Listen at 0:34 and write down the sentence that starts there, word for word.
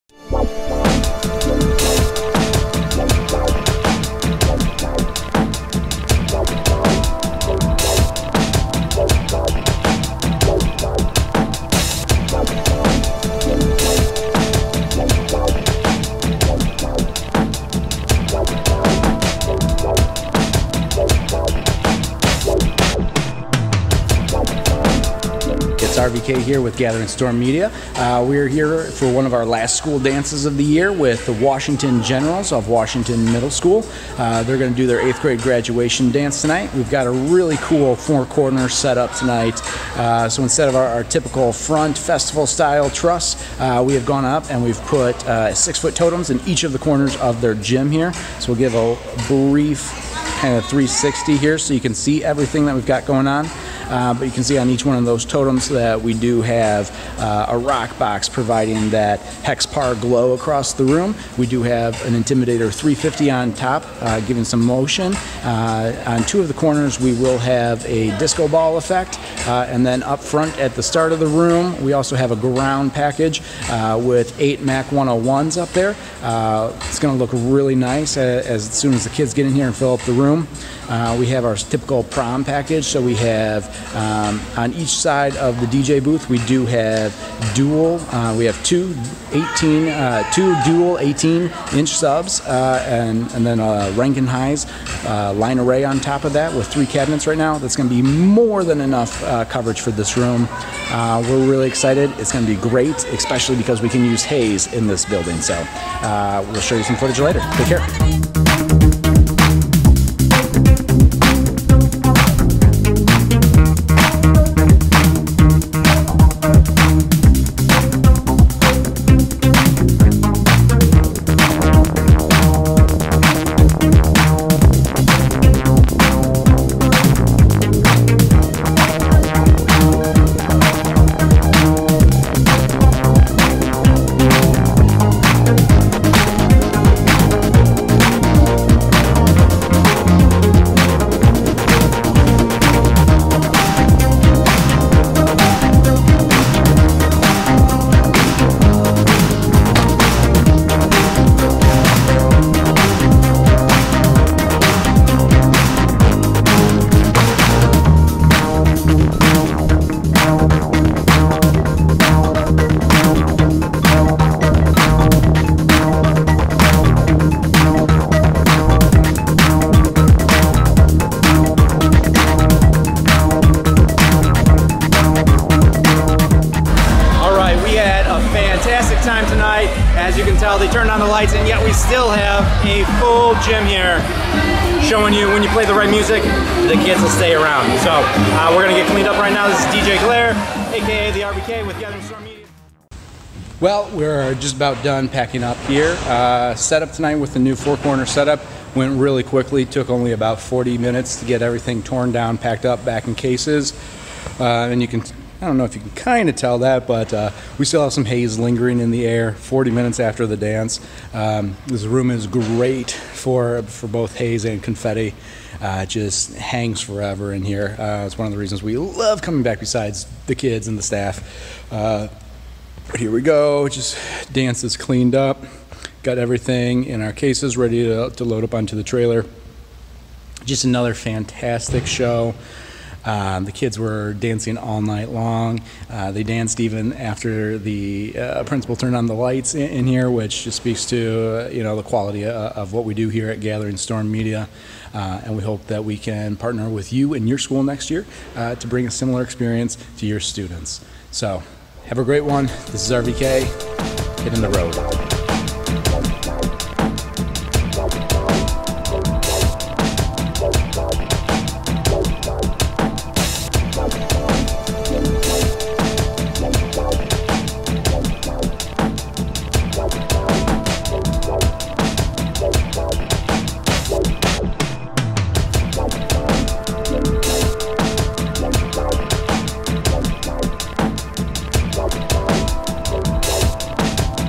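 Uh, they're going to do their eighth grade graduation dance tonight.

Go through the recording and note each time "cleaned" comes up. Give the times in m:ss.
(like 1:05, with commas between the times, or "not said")
3:08, 3:44.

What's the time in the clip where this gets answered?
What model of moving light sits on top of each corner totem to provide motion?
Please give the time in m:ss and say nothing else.
1:02.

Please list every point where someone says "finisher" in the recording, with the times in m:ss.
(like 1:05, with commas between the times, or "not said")
not said.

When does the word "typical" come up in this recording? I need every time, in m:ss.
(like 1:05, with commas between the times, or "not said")
0:41, 1:21.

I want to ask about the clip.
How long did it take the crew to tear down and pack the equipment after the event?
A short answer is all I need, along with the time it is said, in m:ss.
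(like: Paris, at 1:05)
40 minutes, at 3:20.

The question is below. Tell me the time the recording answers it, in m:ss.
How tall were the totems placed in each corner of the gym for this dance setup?
0:45.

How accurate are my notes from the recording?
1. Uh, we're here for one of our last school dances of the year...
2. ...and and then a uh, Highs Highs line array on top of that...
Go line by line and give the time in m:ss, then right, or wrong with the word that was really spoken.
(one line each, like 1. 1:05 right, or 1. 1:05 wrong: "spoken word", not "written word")
1. 0:27 right
2. 1:32 wrong: "Rankin", not "Highs".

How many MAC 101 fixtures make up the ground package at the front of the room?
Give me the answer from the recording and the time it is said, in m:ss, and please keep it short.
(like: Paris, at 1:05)
8, at 1:14.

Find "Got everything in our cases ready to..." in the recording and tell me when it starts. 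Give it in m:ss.
3:46.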